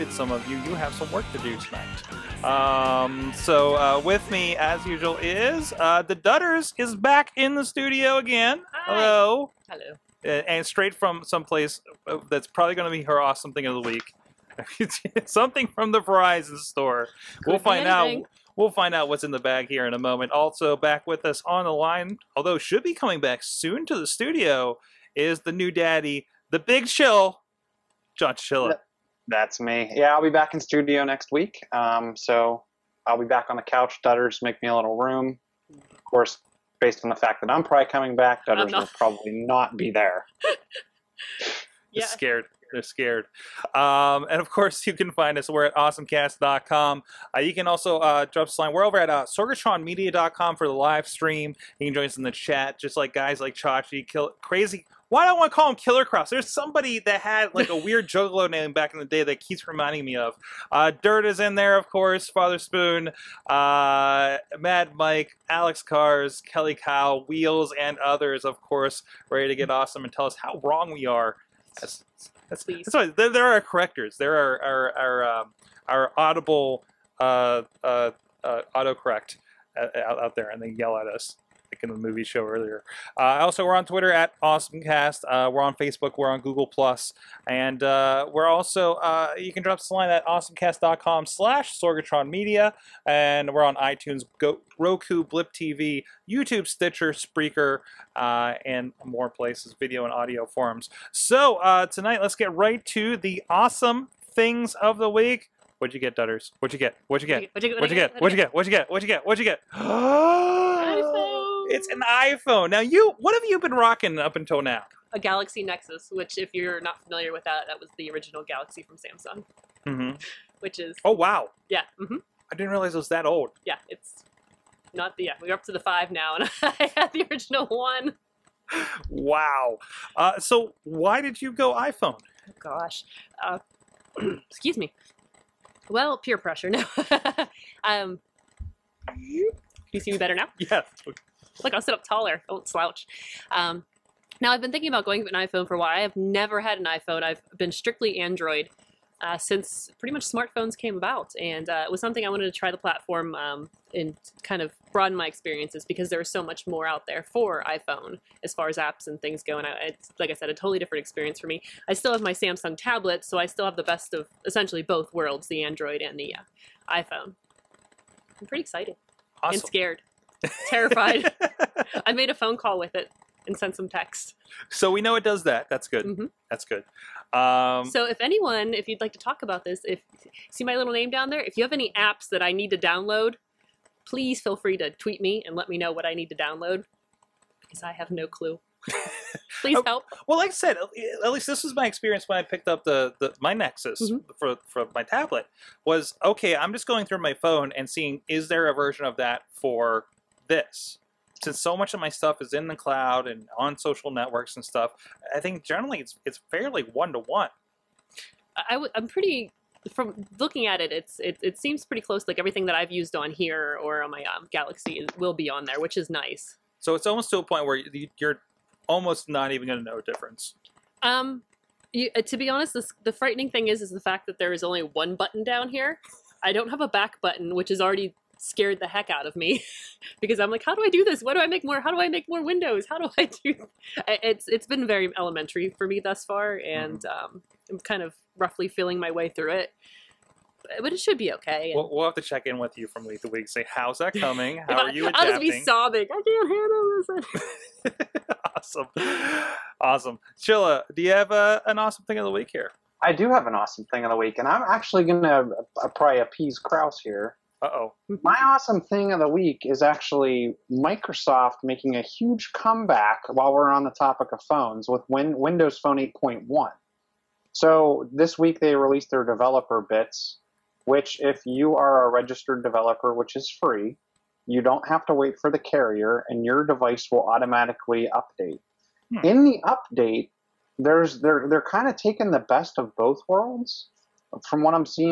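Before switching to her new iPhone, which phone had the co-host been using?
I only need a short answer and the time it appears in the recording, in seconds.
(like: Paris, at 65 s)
Galaxy Nexus, at 115 s.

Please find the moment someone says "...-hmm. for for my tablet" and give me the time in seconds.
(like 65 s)
194 s.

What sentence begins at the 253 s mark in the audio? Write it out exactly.
I do have an awesome thing of the week, and I'm actually going to uh, probably appease Kraus here uh-oh.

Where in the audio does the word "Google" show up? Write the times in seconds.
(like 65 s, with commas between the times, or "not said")
86 s.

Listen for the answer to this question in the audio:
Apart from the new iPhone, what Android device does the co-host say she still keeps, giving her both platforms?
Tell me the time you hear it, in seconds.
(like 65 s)
162 s.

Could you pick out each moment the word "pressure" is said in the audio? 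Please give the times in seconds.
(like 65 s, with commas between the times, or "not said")
136 s.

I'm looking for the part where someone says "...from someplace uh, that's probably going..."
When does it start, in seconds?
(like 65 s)
10 s.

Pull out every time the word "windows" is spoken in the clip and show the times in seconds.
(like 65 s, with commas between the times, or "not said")
232 s, 265 s.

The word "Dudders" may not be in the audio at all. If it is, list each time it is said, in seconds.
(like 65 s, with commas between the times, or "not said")
6 s, 34 s, 38 s, 106 s.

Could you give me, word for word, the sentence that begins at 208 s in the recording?
I w- I'm pretty from looking at it, it's it, it seems pretty close.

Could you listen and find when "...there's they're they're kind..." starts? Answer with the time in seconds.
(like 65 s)
280 s.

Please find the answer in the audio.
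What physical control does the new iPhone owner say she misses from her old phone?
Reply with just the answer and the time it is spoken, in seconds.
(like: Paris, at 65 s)
back button, at 226 s.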